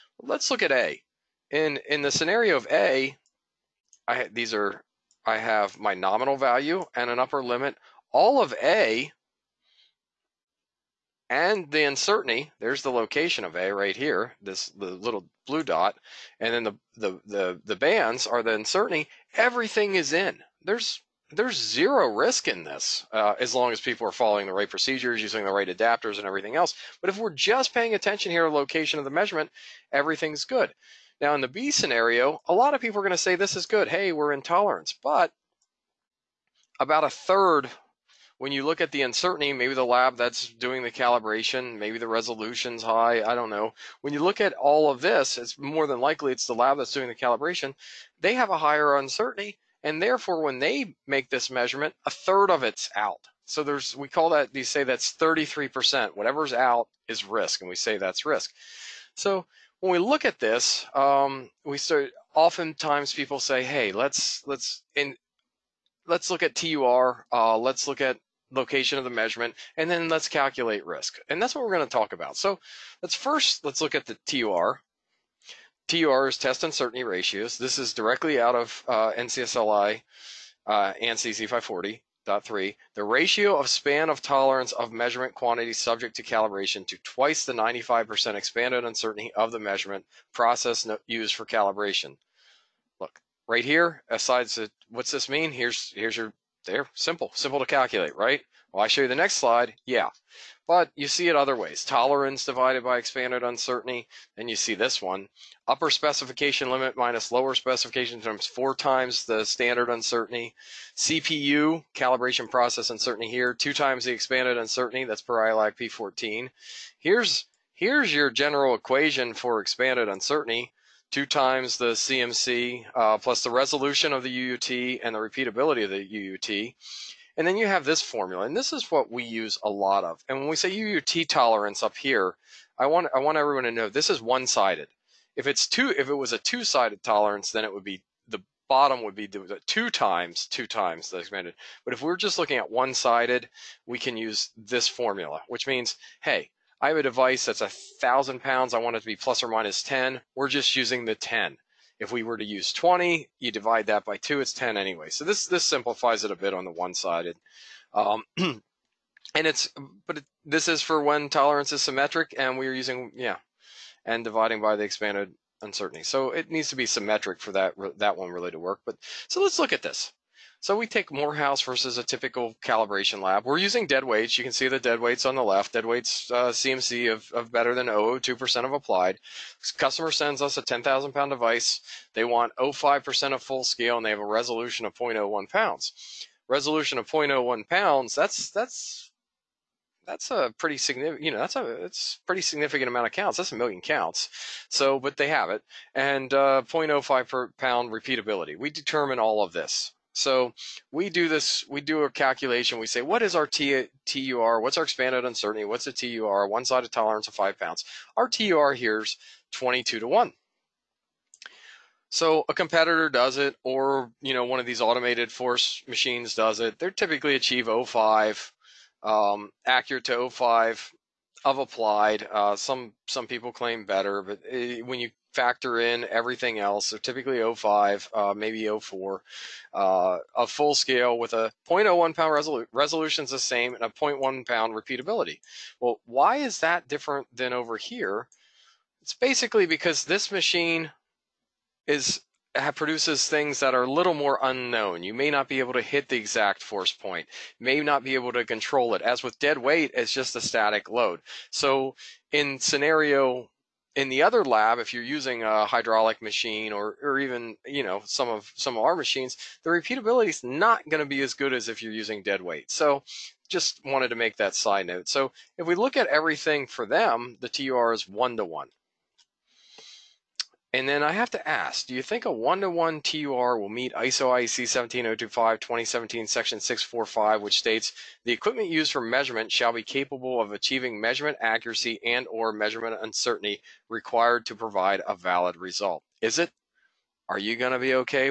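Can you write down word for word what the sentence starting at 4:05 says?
You may not be able to hit the exact force point, may not be able to control it.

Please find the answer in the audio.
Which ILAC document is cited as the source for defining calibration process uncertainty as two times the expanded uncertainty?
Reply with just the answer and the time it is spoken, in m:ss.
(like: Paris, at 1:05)
ILAC P14, at 1:55.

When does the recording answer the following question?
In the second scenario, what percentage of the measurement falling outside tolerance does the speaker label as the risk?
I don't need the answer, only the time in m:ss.
0:55.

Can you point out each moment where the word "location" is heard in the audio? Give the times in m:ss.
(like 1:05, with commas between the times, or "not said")
0:12, 0:28, 1:08.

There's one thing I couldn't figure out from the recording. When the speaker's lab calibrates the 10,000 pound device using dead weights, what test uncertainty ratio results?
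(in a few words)
22 to 1.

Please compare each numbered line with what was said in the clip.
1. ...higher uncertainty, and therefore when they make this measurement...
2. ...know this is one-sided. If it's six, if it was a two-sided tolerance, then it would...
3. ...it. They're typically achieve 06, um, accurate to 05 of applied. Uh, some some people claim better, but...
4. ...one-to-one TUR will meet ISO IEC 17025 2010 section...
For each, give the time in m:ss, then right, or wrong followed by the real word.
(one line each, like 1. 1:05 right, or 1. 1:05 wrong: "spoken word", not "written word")
1. 0:48 right
2. 2:13 wrong: "two", not "six"
3. 3:36 wrong: "05", not "06"
4. 4:32 wrong: "2017", not "2010".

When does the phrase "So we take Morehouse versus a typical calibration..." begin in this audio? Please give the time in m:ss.
2:50.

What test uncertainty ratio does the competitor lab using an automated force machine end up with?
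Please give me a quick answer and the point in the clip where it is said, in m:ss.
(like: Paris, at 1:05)
1 to 1, at 4:28.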